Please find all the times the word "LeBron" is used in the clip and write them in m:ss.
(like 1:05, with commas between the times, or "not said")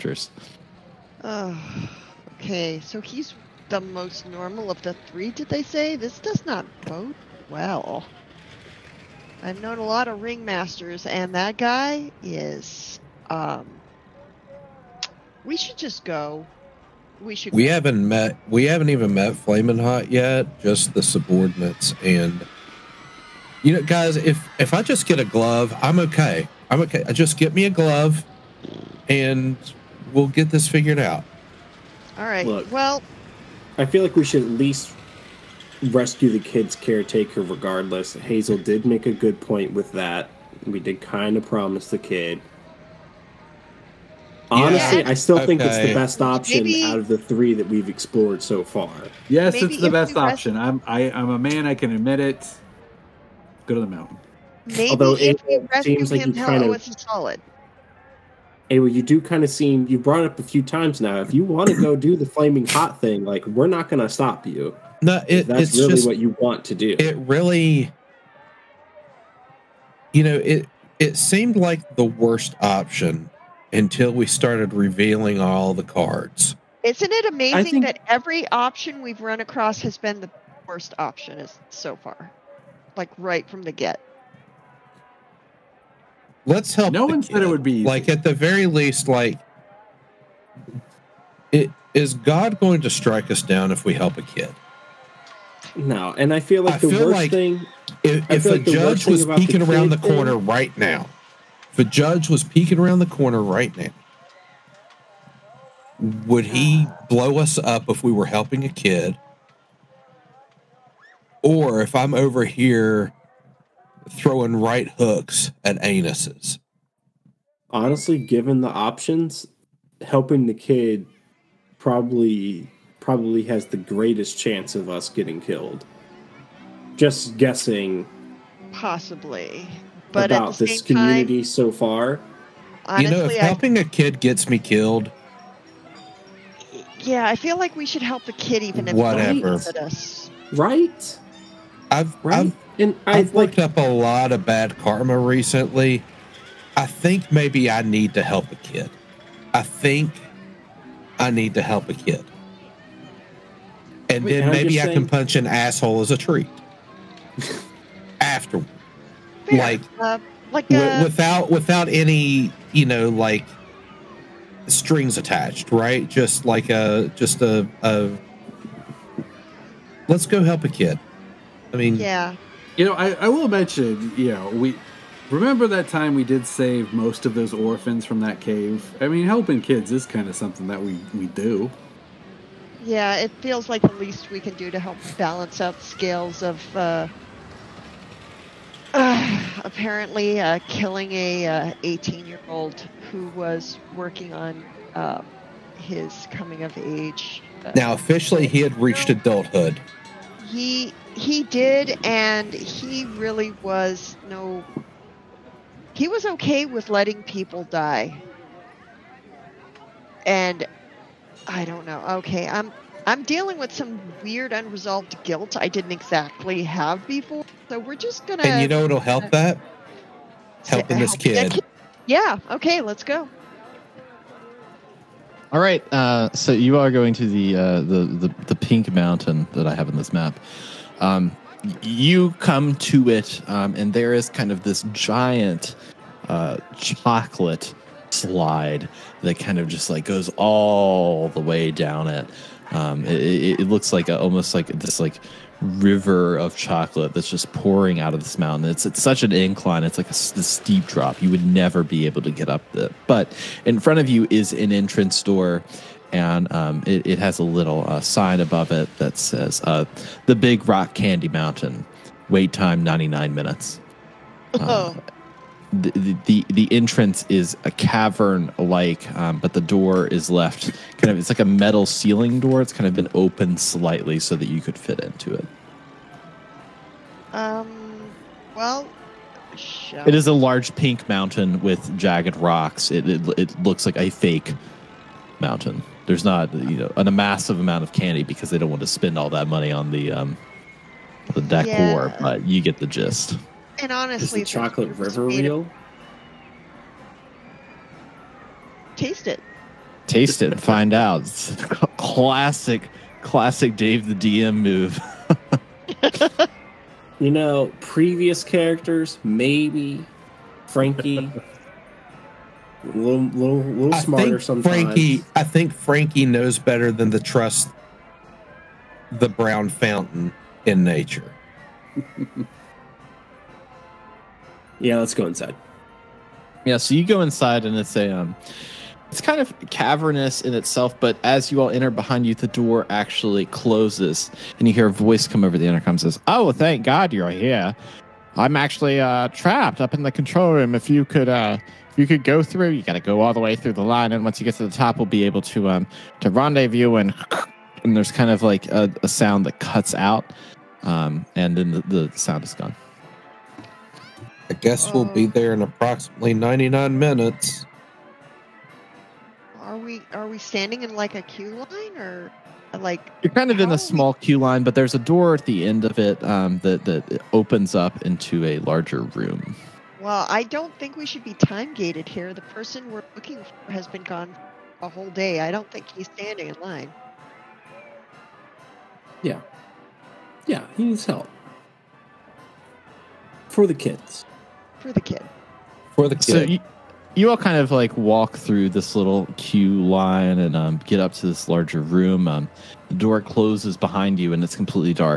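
not said.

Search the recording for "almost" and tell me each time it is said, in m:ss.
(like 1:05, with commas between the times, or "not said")
4:04.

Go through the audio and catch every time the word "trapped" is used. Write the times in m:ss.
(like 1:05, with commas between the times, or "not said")
5:39.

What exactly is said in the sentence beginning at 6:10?
Well, I don't think we should be time gated here.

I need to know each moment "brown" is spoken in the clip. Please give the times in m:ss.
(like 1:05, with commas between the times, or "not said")
5:19.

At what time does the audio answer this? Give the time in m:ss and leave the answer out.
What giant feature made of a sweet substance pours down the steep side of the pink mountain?
3:56.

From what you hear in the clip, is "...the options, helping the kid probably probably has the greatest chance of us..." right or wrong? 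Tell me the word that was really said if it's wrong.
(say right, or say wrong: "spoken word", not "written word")
right.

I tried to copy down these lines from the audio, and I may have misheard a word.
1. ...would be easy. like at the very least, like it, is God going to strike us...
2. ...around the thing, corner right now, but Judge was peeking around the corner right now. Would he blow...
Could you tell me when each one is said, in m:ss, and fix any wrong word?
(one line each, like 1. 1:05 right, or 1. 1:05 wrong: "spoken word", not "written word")
1. 1:27 right
2. 1:39 right.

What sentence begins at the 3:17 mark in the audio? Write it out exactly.
Uh, now, officially, he had reached adulthood.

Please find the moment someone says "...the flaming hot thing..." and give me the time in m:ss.
1:02.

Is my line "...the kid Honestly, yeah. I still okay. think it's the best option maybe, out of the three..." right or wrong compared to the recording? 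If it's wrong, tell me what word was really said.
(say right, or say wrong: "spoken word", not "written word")
right.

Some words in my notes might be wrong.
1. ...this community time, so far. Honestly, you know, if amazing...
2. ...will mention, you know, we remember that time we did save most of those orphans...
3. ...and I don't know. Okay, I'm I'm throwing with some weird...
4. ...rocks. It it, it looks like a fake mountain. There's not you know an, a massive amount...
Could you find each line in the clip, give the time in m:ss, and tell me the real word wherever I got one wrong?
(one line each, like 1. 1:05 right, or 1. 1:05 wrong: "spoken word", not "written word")
1. 2:10 wrong: "helping", not "amazing"
2. 2:53 right
3. 3:30 wrong: "dealing", not "throwing"
4. 4:42 right.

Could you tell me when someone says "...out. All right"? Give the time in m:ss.
0:31.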